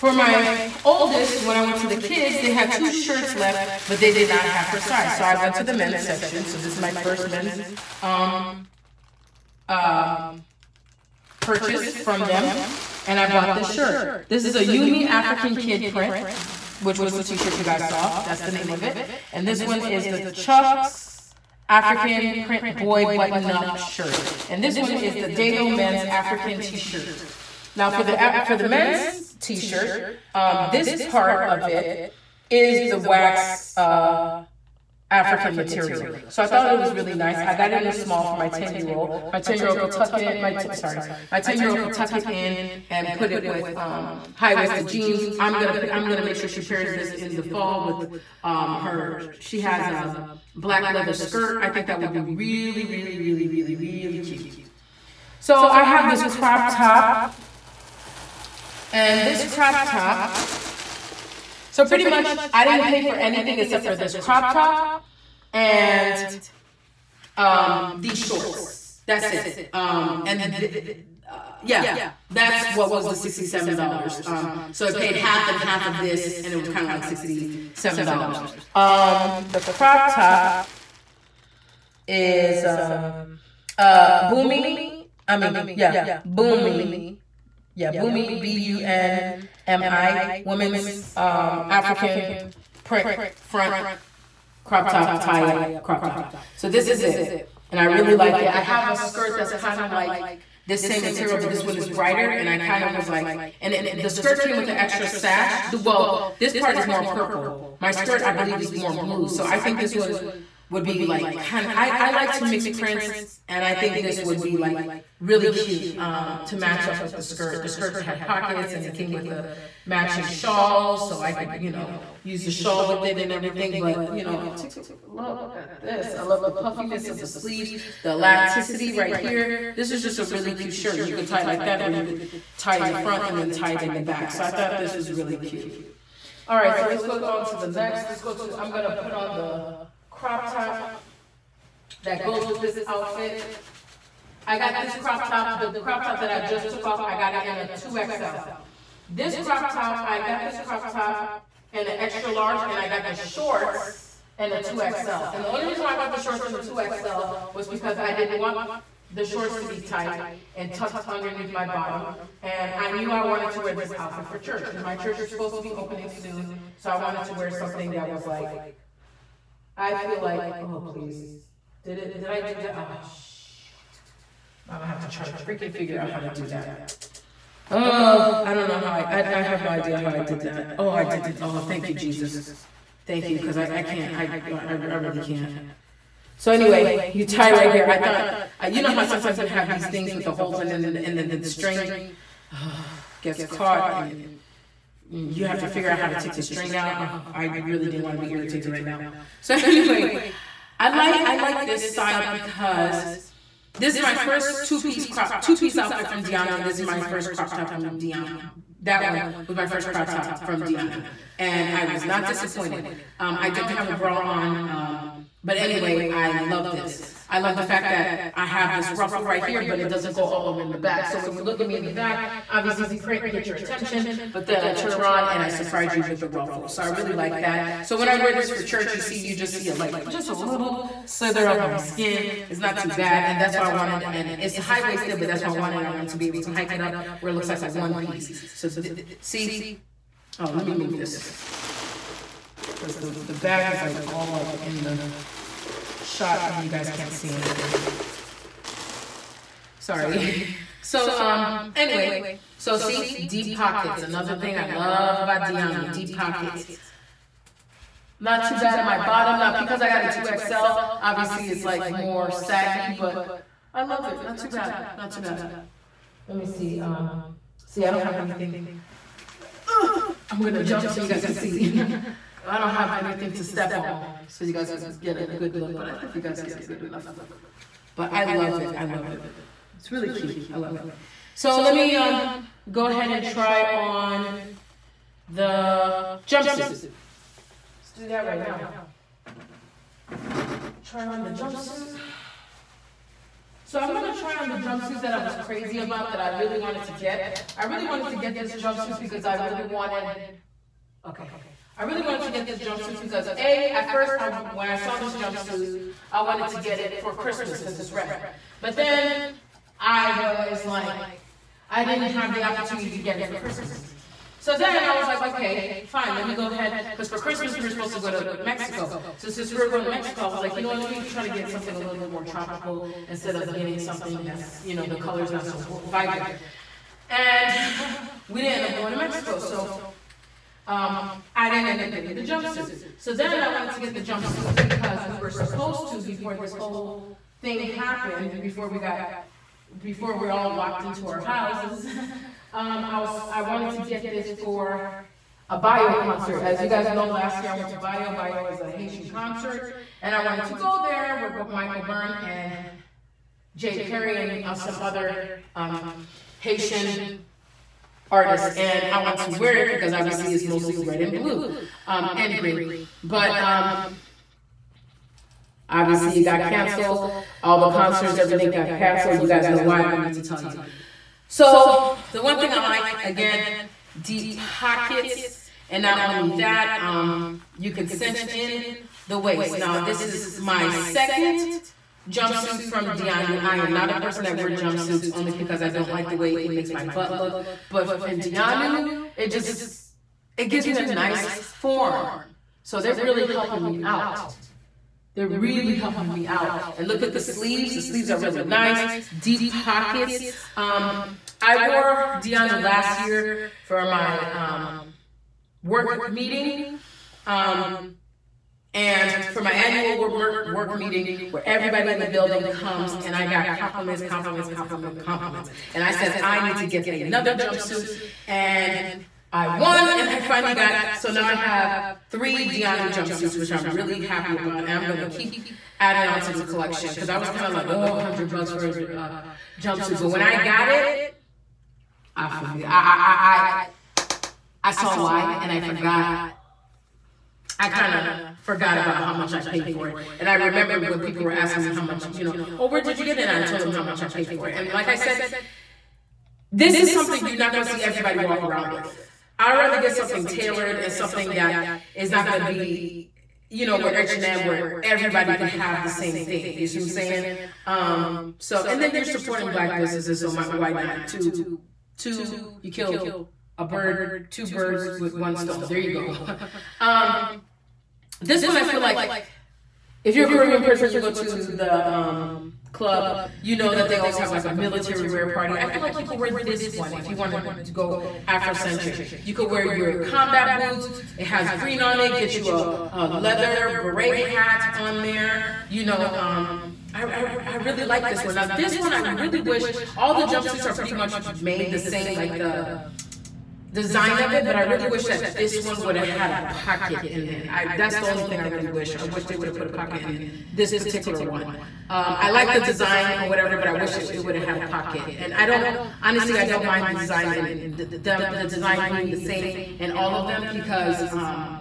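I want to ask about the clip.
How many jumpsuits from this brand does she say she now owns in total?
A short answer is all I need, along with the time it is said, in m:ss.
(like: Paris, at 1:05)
3, at 7:02.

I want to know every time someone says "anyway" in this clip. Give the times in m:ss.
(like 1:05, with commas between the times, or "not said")
3:06, 3:19, 3:35, 4:11.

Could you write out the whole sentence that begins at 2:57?
Oh, I don't know how I, I, I have no idea how I did that.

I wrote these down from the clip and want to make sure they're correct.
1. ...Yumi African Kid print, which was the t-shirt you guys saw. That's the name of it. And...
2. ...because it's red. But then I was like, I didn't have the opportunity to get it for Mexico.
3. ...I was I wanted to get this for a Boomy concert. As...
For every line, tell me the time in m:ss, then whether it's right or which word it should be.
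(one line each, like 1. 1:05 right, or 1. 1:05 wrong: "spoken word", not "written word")
1. 0:14 right
2. 5:07 wrong: "Christmas", not "Mexico"
3. 5:42 wrong: "Bayo", not "Boomy".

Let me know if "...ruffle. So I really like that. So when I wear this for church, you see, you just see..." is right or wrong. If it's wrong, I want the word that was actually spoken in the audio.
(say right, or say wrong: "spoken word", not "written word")
right.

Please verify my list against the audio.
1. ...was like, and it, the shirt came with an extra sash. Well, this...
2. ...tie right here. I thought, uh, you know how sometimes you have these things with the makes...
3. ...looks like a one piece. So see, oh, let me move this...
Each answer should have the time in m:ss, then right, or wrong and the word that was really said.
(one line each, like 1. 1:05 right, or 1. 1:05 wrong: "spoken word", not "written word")
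1. 1:42 wrong: "skirt", not "shirt"
2. 3:07 wrong: "holes", not "makes"
3. 3:57 right.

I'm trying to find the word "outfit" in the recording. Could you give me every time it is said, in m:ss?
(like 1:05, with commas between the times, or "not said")
2:22, 2:43, 3:25.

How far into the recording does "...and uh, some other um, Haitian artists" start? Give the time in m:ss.
5:54.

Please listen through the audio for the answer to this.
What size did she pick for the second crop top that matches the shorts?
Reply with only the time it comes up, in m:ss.
2:31.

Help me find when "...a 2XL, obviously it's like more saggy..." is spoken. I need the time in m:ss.
4:20.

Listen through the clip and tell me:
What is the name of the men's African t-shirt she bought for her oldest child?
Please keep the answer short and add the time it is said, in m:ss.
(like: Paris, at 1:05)
Dayo, at 0:25.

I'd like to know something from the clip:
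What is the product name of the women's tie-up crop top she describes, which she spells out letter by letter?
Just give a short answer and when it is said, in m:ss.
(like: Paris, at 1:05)
Bunmi, at 1:28.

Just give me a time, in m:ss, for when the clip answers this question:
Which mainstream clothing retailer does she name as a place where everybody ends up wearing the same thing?
7:33.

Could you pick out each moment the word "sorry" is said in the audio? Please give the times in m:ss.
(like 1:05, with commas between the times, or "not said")
0:40, 4:09.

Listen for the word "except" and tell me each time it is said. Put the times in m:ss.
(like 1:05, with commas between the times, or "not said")
1:03.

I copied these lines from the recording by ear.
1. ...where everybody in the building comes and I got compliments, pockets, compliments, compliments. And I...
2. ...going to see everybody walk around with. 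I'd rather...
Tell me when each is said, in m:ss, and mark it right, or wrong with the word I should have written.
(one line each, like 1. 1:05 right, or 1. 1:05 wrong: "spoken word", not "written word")
1. 6:51 wrong: "compliments", not "pockets"
2. 7:27 right.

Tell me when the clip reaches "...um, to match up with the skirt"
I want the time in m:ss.
1:55.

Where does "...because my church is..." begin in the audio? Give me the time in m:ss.
2:44.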